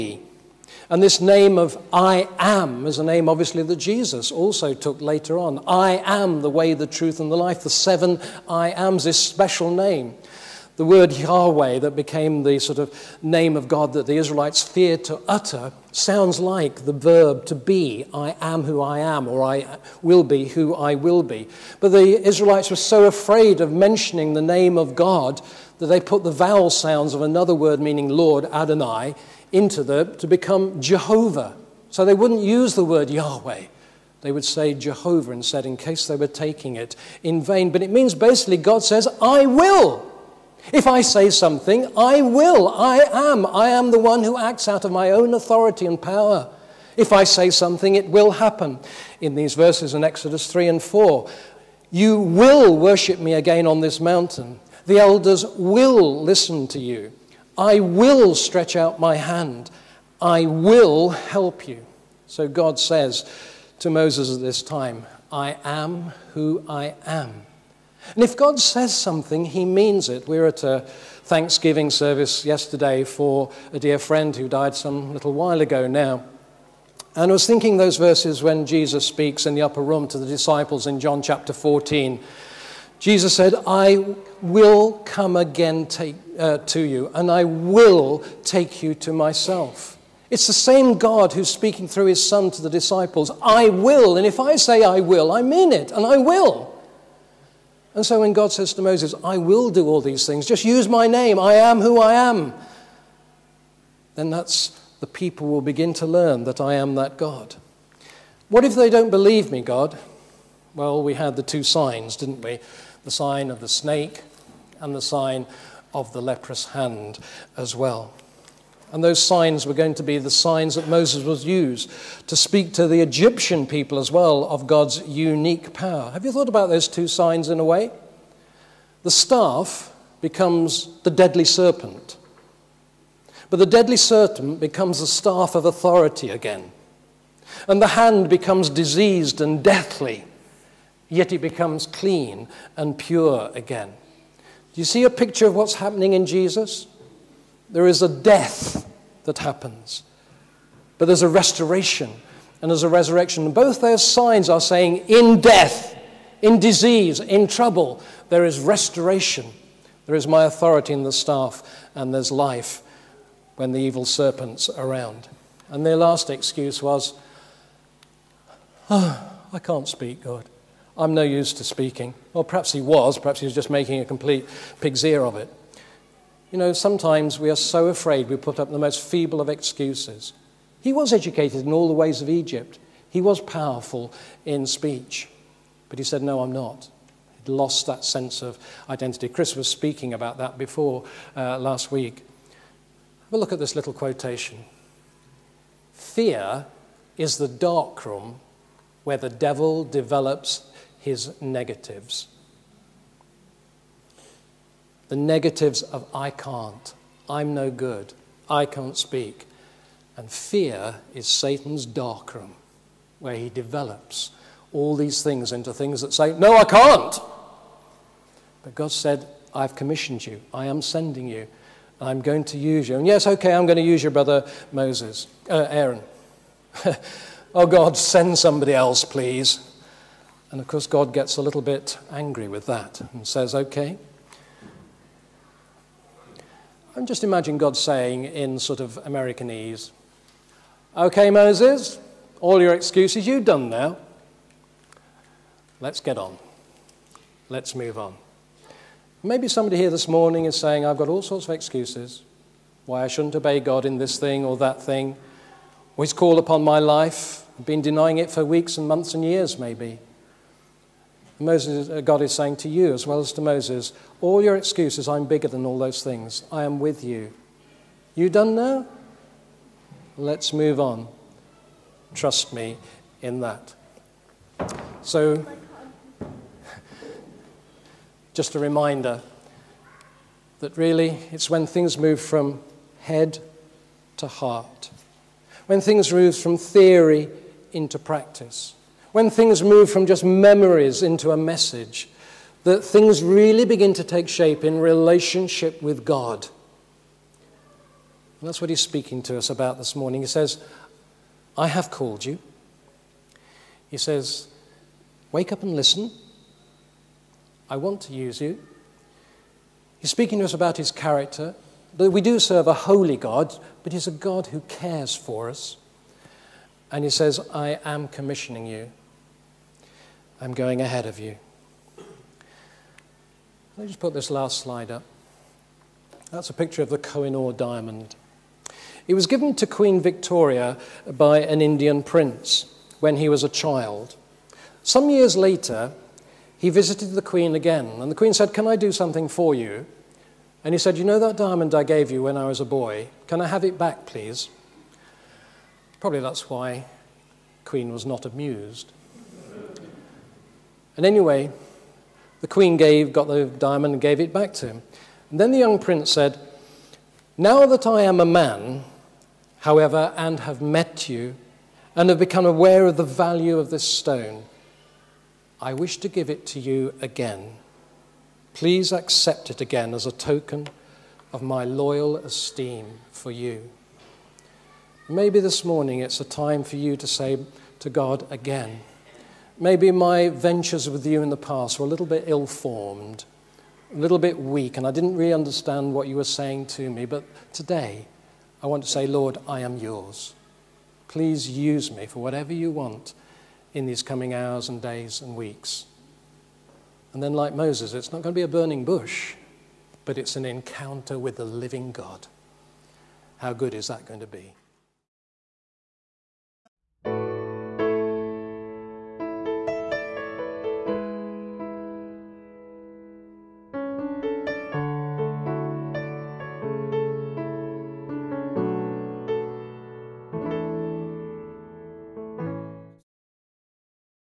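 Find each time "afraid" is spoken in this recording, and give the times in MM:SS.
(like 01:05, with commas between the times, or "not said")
00:23, 02:57.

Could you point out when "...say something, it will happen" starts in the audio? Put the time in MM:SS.
00:47.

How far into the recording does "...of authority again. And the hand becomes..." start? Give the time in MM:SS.
02:15.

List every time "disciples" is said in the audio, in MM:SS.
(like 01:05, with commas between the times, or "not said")
01:20, 01:32.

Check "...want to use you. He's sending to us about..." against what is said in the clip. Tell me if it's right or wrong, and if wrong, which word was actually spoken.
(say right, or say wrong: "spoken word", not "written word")
wrong: "speaking", not "sending".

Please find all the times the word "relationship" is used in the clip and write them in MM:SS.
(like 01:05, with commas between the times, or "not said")
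04:54.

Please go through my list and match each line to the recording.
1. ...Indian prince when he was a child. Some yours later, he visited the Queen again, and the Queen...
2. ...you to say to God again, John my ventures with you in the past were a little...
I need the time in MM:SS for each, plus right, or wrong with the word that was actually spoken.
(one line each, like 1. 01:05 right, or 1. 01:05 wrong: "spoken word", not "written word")
1. 05:31 wrong: "years", not "yours"
2. 06:16 wrong: "Maybe", not "John".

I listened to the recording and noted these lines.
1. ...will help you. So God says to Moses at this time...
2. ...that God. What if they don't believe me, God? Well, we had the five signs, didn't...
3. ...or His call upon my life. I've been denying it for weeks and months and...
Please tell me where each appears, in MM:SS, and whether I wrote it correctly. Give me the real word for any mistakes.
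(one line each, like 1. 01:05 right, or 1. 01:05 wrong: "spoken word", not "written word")
1. 01:00 right
2. 01:46 wrong: "two", not "five"
3. 04:15 right.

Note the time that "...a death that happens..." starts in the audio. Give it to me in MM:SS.
02:28.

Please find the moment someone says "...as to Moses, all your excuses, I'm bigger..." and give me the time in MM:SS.
04:23.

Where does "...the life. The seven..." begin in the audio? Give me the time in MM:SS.
00:07.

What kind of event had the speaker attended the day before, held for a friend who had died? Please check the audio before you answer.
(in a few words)
Thanksgiving service.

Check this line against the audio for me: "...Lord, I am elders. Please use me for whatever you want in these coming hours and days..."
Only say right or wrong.
wrong.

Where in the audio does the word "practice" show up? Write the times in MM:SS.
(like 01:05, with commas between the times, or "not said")
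04:47.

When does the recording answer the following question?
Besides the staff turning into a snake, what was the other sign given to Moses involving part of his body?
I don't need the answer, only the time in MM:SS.
01:56.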